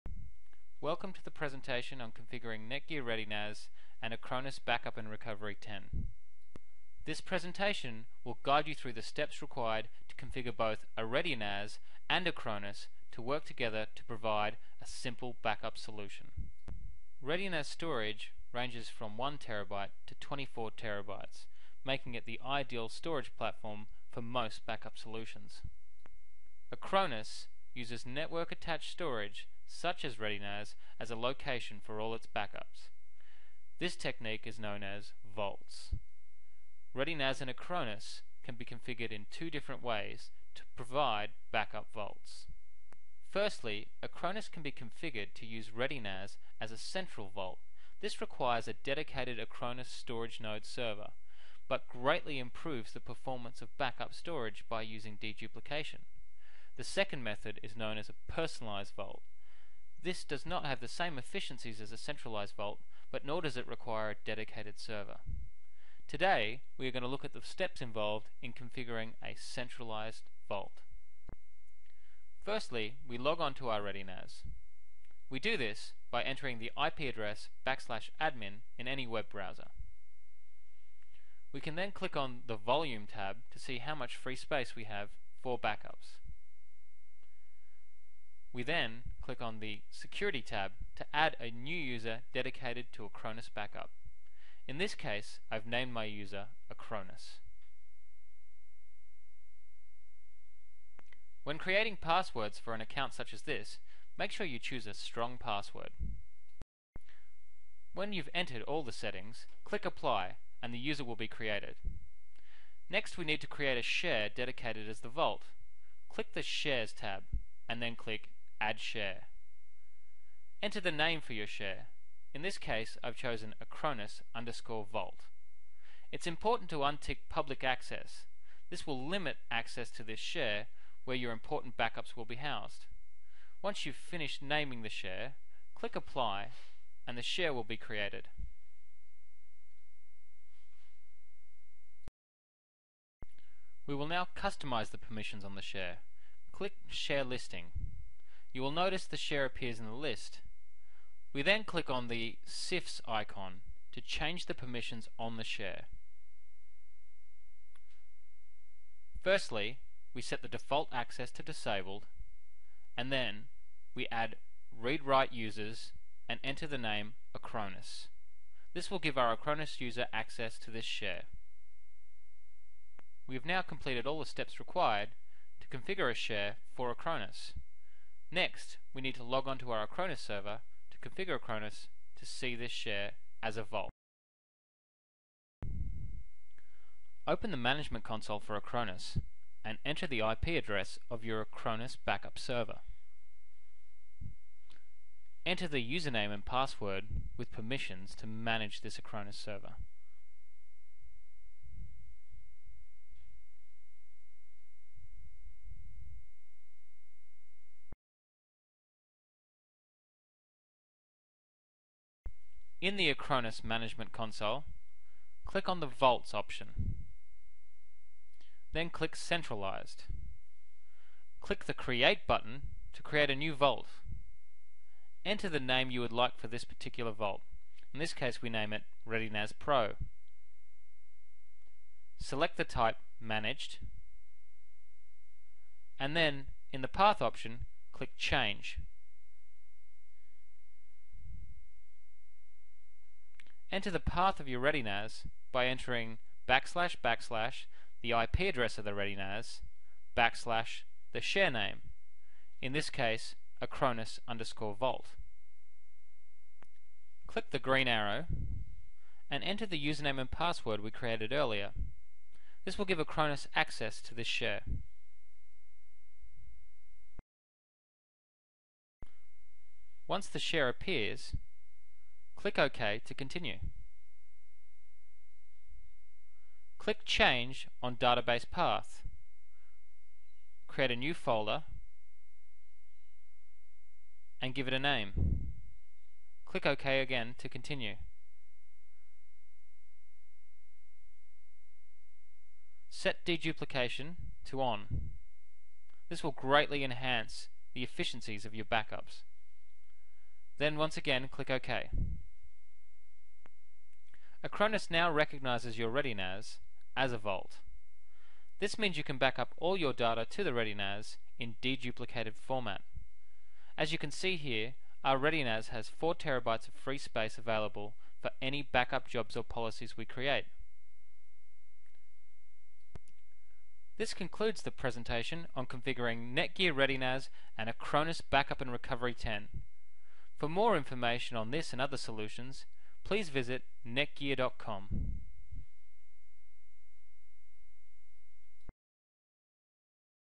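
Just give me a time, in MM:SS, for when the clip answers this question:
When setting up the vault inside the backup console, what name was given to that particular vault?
03:49.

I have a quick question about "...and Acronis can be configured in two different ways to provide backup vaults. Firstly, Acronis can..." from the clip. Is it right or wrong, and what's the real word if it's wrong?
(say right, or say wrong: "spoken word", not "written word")
right.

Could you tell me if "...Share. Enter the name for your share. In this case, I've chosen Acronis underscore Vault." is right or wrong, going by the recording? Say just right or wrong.
right.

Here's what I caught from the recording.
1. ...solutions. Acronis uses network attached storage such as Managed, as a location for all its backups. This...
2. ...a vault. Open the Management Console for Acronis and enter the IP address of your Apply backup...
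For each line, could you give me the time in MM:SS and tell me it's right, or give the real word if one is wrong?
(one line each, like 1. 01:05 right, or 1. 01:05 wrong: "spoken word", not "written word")
1. 00:24 wrong: "ReadyNAS", not "Managed"
2. 03:03 wrong: "Acronis", not "Apply".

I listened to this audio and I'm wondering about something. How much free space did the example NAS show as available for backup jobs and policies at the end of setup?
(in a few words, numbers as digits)
4 terabytes.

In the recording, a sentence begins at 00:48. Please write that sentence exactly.
This requires a dedicated Acronis storage node server, but greatly improves the performance of backup storage by using deduplication.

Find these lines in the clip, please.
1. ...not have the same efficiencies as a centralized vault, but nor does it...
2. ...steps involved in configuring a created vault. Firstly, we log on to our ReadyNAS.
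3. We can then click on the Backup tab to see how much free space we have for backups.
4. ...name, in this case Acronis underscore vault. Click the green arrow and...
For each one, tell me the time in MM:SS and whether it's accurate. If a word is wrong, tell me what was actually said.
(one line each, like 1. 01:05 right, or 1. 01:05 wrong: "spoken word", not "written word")
1. 01:00 right
2. 01:07 wrong: "centralized", not "created"
3. 01:21 wrong: "Volume", not "Backup"
4. 04:11 right.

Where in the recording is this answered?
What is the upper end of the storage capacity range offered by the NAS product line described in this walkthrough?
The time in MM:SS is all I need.
00:20.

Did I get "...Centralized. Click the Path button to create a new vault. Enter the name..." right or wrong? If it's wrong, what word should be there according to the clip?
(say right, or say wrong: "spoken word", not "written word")
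wrong: "Create", not "Path".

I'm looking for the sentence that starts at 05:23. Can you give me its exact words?
This concludes the presentation on configuring Netgear ReadyNAS and Acronis Backup and Recovery 10.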